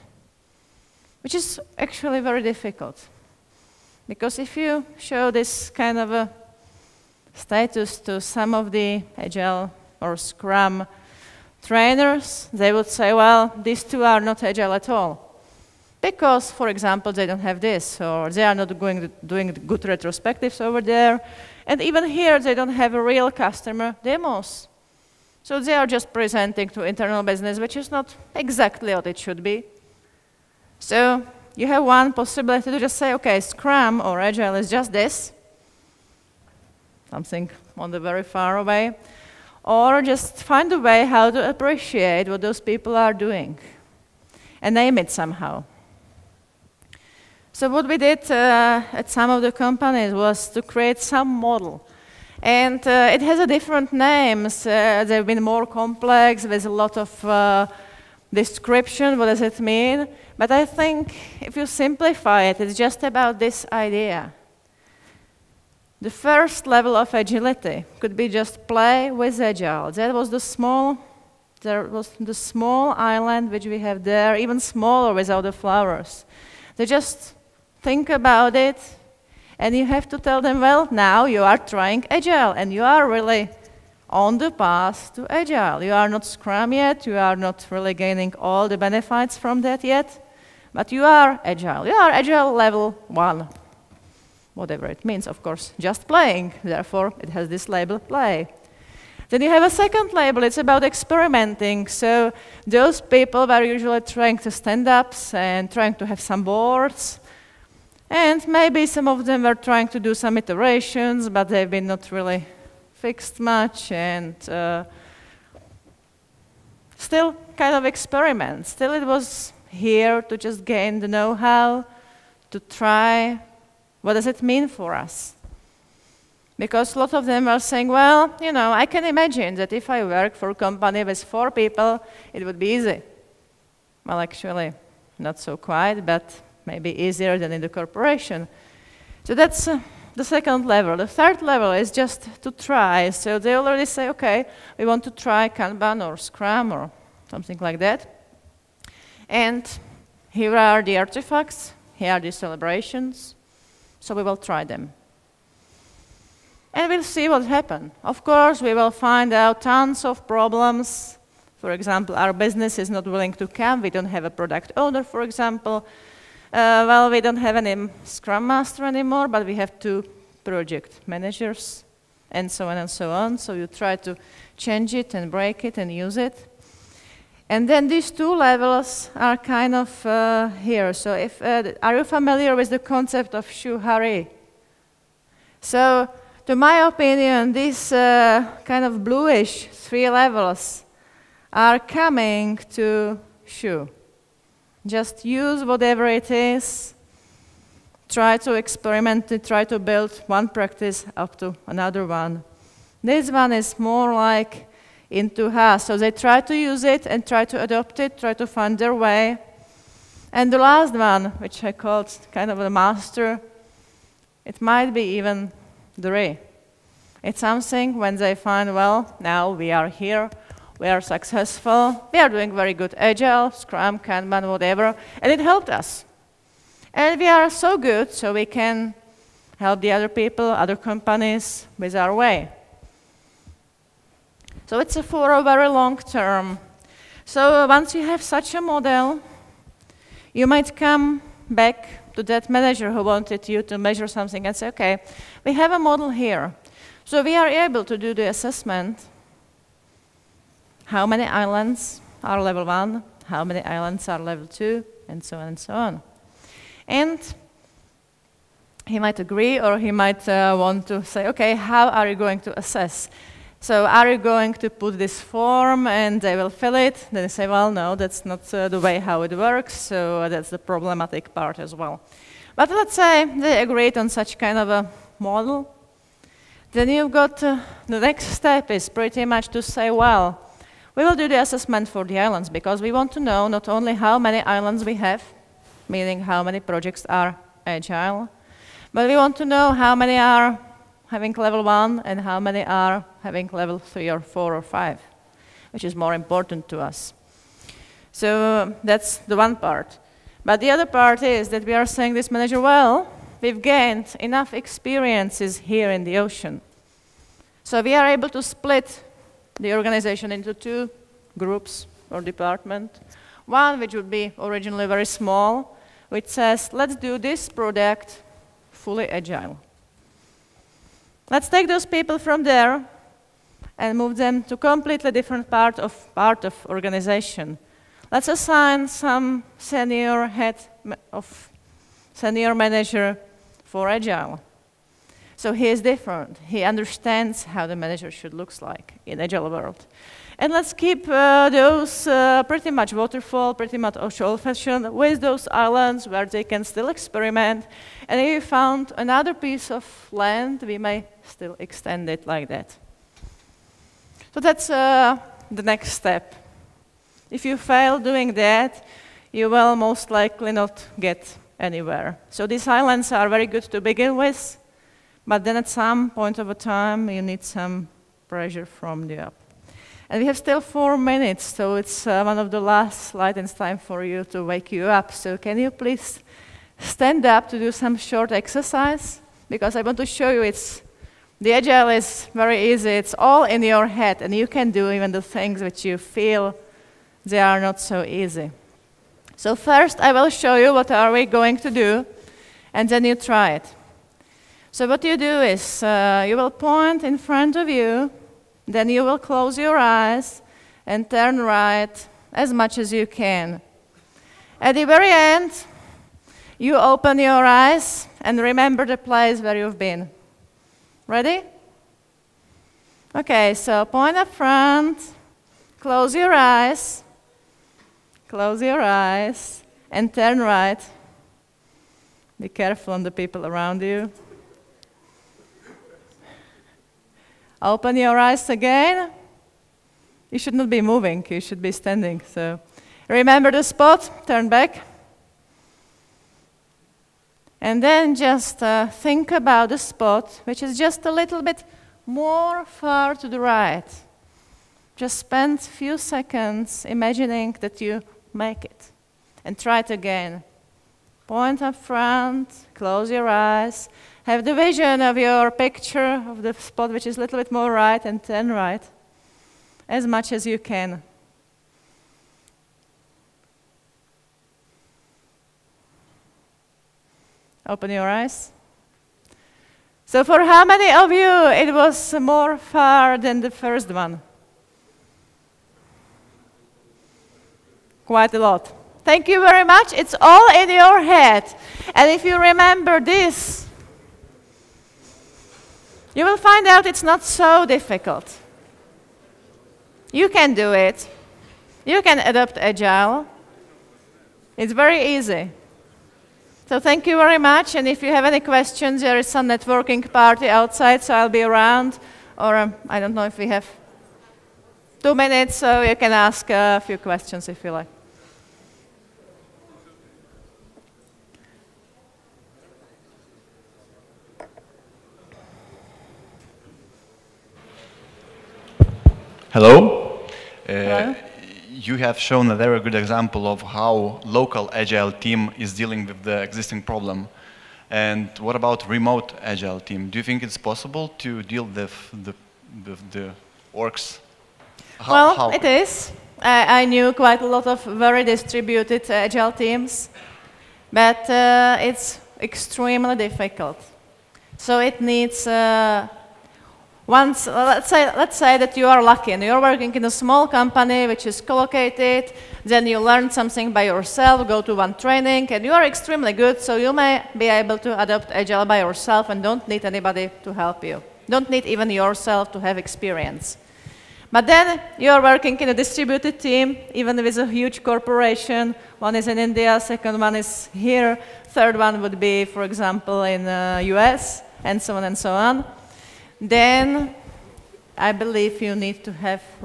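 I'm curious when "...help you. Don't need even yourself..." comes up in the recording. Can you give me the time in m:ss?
9:20.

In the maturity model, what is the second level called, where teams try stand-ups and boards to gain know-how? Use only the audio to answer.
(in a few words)
Experimenting.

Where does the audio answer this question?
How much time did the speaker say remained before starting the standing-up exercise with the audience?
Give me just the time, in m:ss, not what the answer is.
6:10.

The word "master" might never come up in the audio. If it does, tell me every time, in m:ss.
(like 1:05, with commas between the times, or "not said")
2:48, 3:32.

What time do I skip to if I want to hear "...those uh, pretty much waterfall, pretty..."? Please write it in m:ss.
5:41.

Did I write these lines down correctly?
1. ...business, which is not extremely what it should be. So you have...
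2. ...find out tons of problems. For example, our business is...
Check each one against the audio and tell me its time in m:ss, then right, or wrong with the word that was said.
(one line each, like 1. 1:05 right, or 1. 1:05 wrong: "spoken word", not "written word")
1. 0:27 wrong: "exactly", not "extremely"
2. 2:38 right.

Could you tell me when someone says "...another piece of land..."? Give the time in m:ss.
5:48.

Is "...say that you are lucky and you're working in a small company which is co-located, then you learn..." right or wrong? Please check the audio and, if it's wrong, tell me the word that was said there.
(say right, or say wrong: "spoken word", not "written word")
right.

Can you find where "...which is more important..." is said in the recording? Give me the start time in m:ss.
4:55.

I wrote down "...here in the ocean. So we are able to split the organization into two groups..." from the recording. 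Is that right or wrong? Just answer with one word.
right.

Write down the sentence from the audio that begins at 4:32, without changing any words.
But let's say they agreed on such kind of a model.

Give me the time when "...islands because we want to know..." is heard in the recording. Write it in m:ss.
4:42.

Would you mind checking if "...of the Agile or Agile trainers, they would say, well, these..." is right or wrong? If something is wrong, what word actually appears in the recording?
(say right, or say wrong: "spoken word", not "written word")
wrong: "Scrum", not "Agile".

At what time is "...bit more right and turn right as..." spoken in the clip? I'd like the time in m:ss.
7:37.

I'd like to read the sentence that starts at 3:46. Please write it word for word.
And we are so good, so we can help the other people, other companies with our way.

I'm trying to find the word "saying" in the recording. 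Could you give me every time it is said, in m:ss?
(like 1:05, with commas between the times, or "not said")
2:07, 5:01.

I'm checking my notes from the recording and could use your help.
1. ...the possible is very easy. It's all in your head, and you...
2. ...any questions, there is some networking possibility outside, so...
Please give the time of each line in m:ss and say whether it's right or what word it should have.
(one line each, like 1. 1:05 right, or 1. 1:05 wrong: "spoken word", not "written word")
1. 6:21 wrong: "agile", not "possible"
2. 8:18 wrong: "party", not "possibility".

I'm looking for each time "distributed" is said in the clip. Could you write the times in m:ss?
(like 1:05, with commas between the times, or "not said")
8:58, 9:25.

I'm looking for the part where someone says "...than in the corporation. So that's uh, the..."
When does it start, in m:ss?
2:17.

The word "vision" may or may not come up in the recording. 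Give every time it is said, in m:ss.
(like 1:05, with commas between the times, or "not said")
7:34.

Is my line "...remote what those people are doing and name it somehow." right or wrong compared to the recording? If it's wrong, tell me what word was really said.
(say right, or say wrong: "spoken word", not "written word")
wrong: "appreciate", not "remote".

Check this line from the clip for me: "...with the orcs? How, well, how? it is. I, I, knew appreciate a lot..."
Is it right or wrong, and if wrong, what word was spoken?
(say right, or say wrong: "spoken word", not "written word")
wrong: "quite", not "appreciate".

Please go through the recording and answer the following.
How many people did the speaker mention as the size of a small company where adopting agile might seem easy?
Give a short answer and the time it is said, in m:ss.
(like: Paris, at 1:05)
4, at 2:11.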